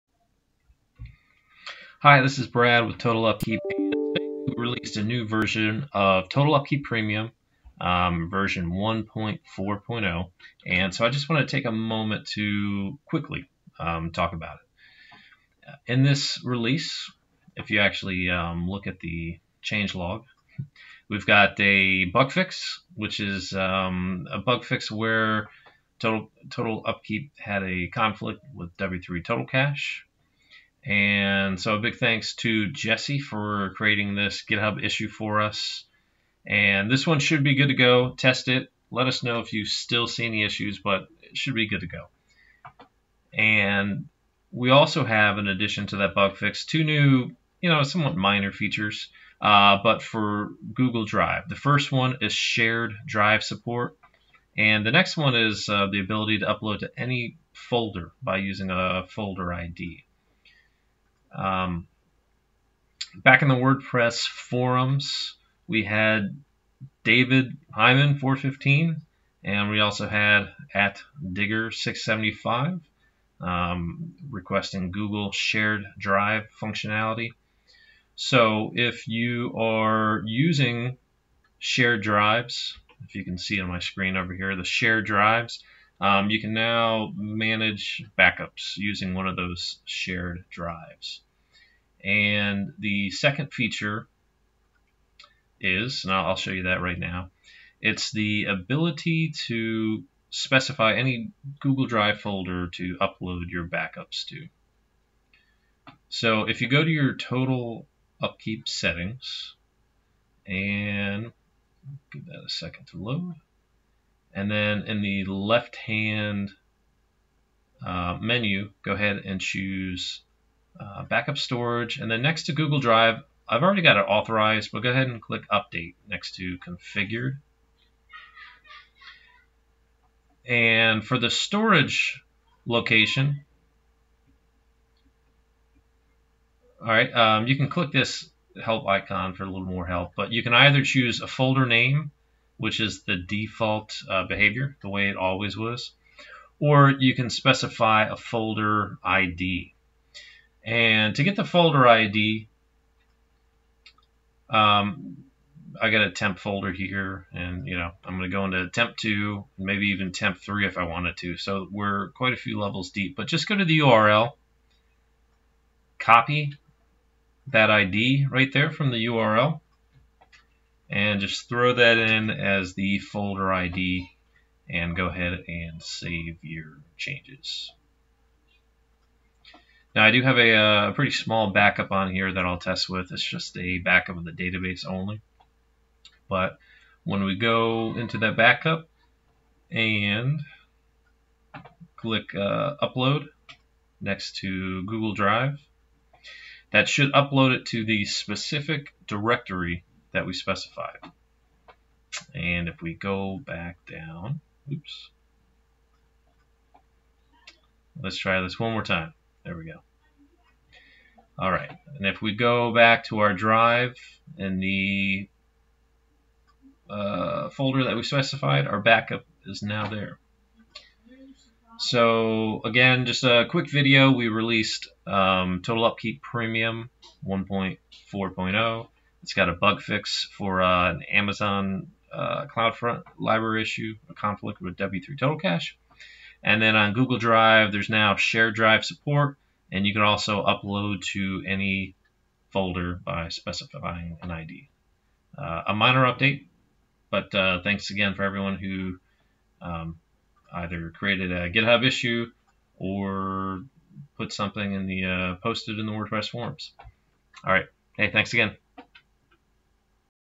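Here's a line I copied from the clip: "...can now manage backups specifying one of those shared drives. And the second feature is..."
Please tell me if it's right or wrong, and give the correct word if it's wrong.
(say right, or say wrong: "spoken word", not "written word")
wrong: "using", not "specifying".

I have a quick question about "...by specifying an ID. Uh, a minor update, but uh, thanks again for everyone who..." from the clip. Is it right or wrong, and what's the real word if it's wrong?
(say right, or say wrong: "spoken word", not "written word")
right.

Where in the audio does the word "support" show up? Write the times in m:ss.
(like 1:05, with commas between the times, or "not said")
0:53, 3:58.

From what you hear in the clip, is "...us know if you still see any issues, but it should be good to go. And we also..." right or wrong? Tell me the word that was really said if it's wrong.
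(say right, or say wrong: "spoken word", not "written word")
right.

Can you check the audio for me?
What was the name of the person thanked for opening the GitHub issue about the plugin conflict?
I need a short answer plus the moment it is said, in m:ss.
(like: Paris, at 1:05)
Jesse, at 0:32.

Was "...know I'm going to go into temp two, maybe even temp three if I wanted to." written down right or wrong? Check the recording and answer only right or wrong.
right.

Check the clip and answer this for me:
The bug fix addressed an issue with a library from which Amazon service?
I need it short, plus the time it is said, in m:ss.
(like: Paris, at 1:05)
CloudFront, at 3:52.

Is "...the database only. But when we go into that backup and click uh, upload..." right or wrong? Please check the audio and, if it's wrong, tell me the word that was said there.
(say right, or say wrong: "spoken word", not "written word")
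right.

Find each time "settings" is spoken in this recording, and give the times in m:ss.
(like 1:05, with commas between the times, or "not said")
1:48.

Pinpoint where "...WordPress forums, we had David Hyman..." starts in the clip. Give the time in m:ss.
1:03.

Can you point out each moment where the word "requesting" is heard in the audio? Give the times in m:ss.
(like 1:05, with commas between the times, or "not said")
1:14.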